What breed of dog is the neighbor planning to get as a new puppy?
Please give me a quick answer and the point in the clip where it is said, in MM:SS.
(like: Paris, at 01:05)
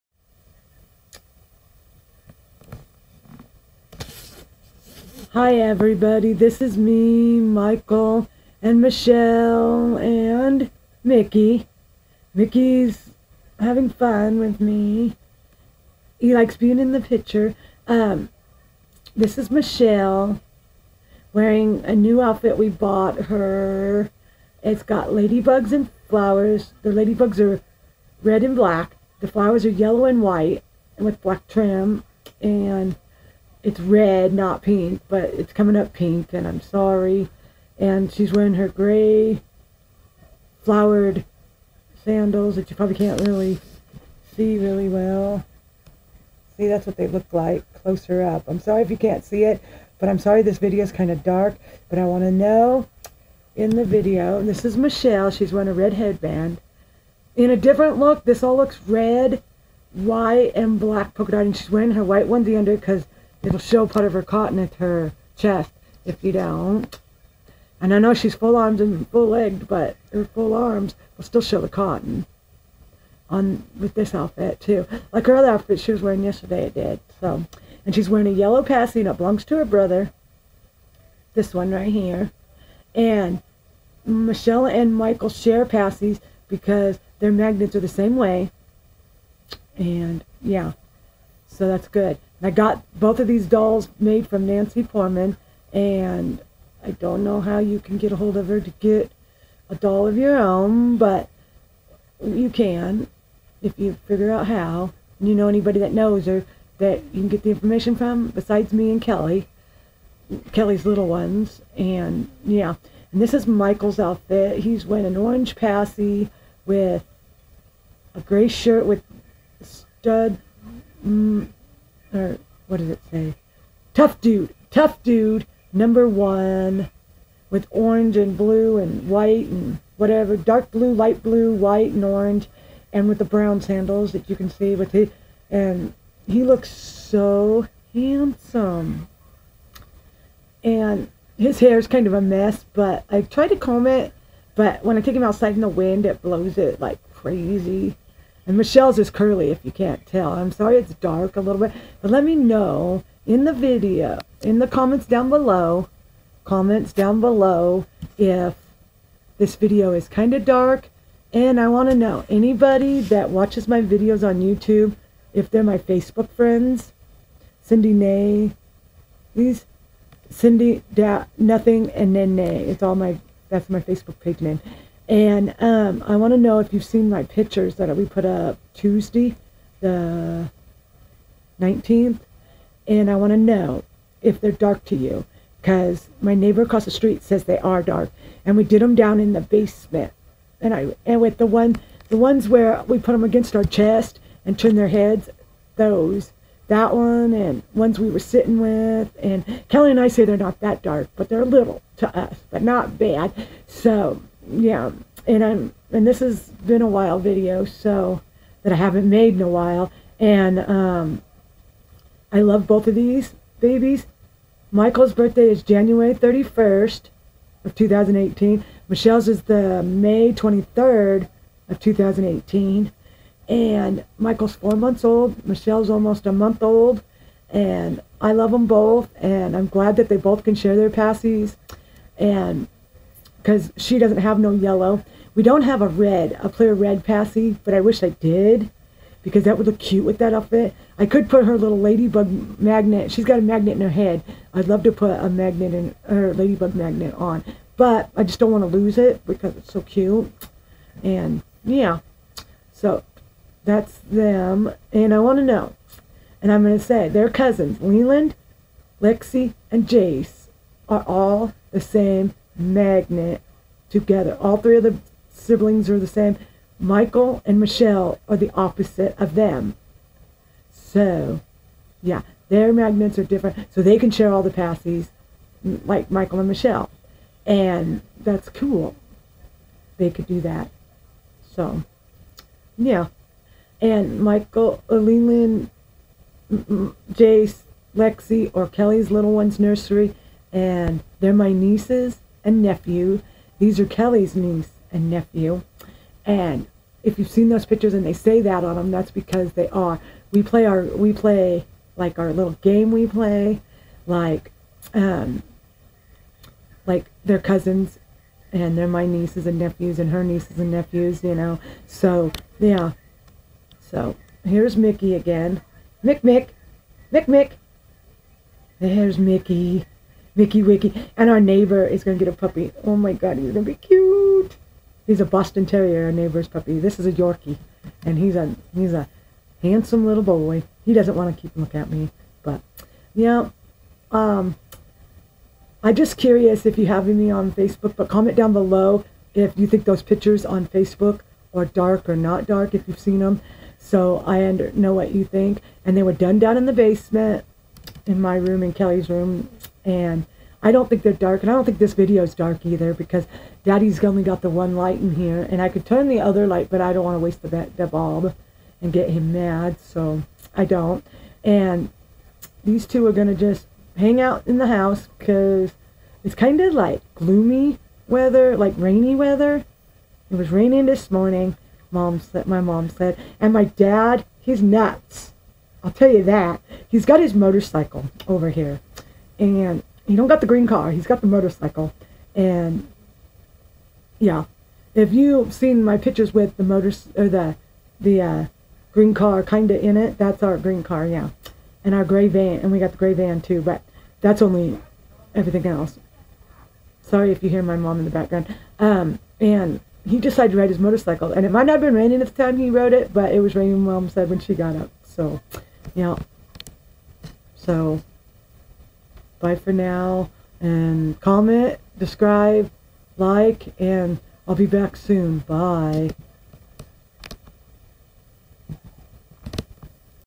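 Boston Terrier, at 05:25.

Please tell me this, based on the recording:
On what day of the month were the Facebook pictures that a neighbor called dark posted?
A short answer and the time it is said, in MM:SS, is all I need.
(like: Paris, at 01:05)
19th, at 02:59.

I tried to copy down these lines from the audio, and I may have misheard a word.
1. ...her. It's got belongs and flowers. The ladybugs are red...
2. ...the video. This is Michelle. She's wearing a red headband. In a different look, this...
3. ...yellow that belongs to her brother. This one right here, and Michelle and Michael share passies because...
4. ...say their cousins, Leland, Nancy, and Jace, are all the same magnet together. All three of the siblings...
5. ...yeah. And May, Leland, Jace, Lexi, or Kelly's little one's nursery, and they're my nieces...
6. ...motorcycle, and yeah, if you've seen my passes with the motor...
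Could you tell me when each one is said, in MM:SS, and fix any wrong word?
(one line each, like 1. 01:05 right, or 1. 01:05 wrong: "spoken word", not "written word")
1. 00:23 wrong: "ladybugs", not "belongs"
2. 00:53 right
3. 01:18 right
4. 04:16 wrong: "Lexi", not "Nancy"
5. 04:42 wrong: "Michael", not "May"
6. 06:21 wrong: "pictures", not "passes".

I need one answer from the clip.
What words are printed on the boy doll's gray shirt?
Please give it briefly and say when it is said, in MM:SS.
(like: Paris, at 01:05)
Tough dude, at 02:03.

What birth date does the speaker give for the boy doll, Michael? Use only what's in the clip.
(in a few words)
January 31st, 2018.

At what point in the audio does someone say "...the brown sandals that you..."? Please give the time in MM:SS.
02:13.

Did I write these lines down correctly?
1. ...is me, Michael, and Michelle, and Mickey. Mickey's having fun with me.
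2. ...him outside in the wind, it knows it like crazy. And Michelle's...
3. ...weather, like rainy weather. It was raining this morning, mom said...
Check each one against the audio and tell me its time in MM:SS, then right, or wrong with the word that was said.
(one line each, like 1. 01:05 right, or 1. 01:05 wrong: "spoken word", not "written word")
1. 00:06 right
2. 02:25 wrong: "blows", not "knows"
3. 06:08 right.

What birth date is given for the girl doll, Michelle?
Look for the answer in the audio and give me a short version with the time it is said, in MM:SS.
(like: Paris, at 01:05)
May 23rd, at 03:39.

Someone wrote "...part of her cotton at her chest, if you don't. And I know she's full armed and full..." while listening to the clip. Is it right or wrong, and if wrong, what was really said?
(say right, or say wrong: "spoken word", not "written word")
right.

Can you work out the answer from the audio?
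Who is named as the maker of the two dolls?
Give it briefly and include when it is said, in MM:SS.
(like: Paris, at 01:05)
Nancy Foreman, at 01:34.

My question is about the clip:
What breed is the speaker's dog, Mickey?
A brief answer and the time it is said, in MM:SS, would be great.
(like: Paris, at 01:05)
Yorkie, at 05:27.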